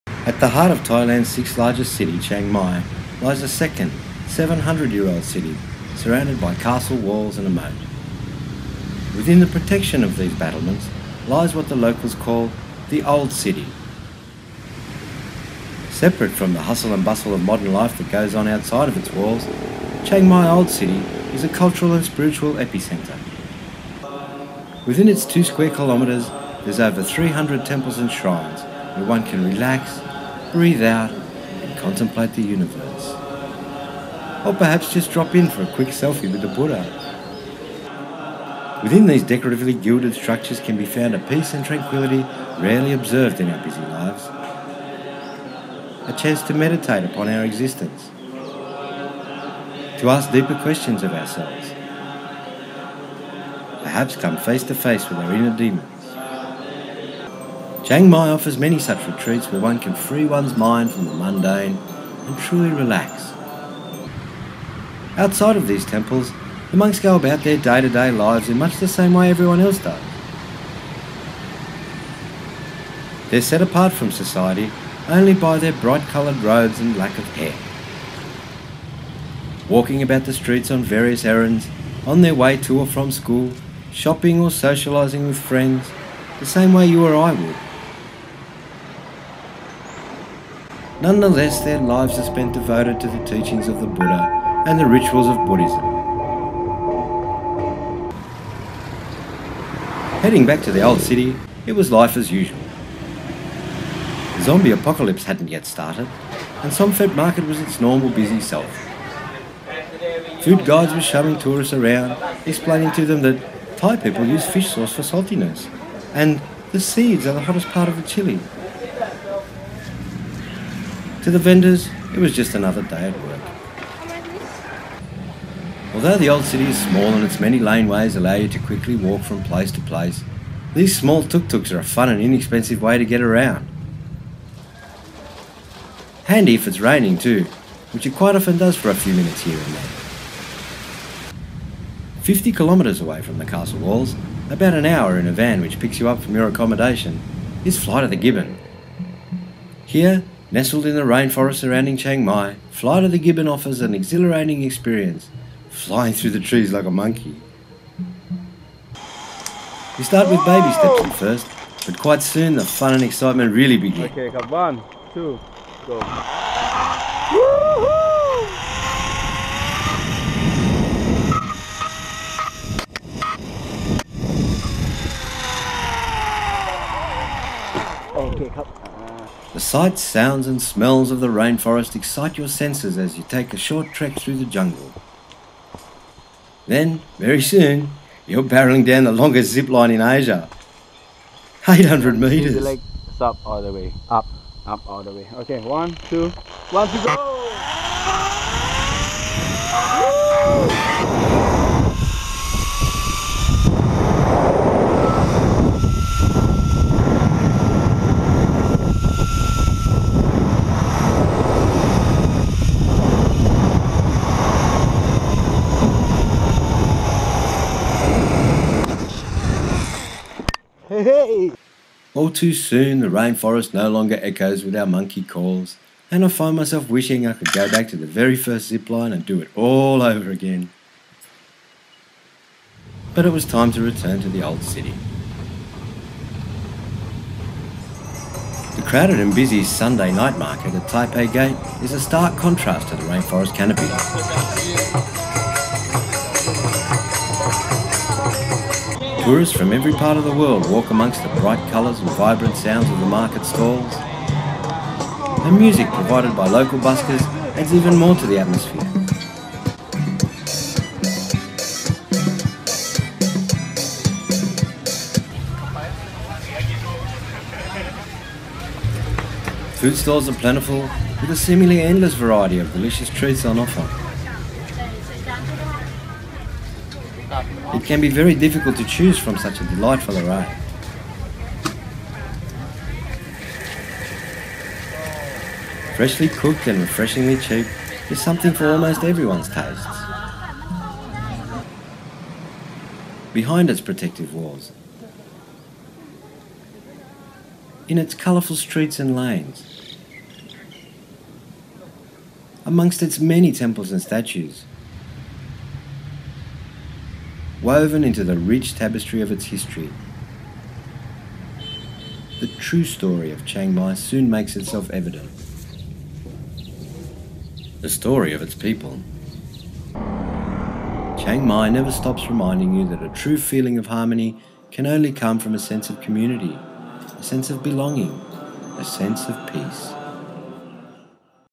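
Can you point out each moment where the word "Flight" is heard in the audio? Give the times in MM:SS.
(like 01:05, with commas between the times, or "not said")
02:27, 02:32.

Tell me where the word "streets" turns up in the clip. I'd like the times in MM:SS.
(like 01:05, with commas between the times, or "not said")
01:20, 04:58.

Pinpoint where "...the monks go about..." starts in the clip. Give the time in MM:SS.
01:06.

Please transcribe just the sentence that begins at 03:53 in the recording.
But it was time to return to the old city.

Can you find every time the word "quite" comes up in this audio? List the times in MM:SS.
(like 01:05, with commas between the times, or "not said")
02:18, 02:41.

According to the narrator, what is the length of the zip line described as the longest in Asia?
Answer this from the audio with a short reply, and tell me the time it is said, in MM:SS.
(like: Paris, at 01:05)
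800 meters, at 03:11.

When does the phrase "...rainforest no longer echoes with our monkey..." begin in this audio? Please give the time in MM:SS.
03:43.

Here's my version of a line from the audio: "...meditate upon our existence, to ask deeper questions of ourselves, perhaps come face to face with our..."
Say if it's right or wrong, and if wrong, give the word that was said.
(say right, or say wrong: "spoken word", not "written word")
right.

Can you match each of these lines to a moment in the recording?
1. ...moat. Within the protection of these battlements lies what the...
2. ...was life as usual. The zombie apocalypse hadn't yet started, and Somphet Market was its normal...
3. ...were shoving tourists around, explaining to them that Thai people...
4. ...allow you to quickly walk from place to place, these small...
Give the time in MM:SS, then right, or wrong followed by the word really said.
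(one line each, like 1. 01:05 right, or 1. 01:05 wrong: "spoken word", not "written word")
1. 00:07 right
2. 01:41 right
3. 01:50 right
4. 02:08 right.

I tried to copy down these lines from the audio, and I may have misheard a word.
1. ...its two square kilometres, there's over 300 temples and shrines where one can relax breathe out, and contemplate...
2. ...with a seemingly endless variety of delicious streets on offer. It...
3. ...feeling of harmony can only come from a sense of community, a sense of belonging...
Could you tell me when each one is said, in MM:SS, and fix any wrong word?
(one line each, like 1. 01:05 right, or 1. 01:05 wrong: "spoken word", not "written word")
1. 00:25 right
2. 04:31 wrong: "treats", not "streets"
3. 05:23 right.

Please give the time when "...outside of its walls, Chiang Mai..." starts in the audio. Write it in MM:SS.
00:18.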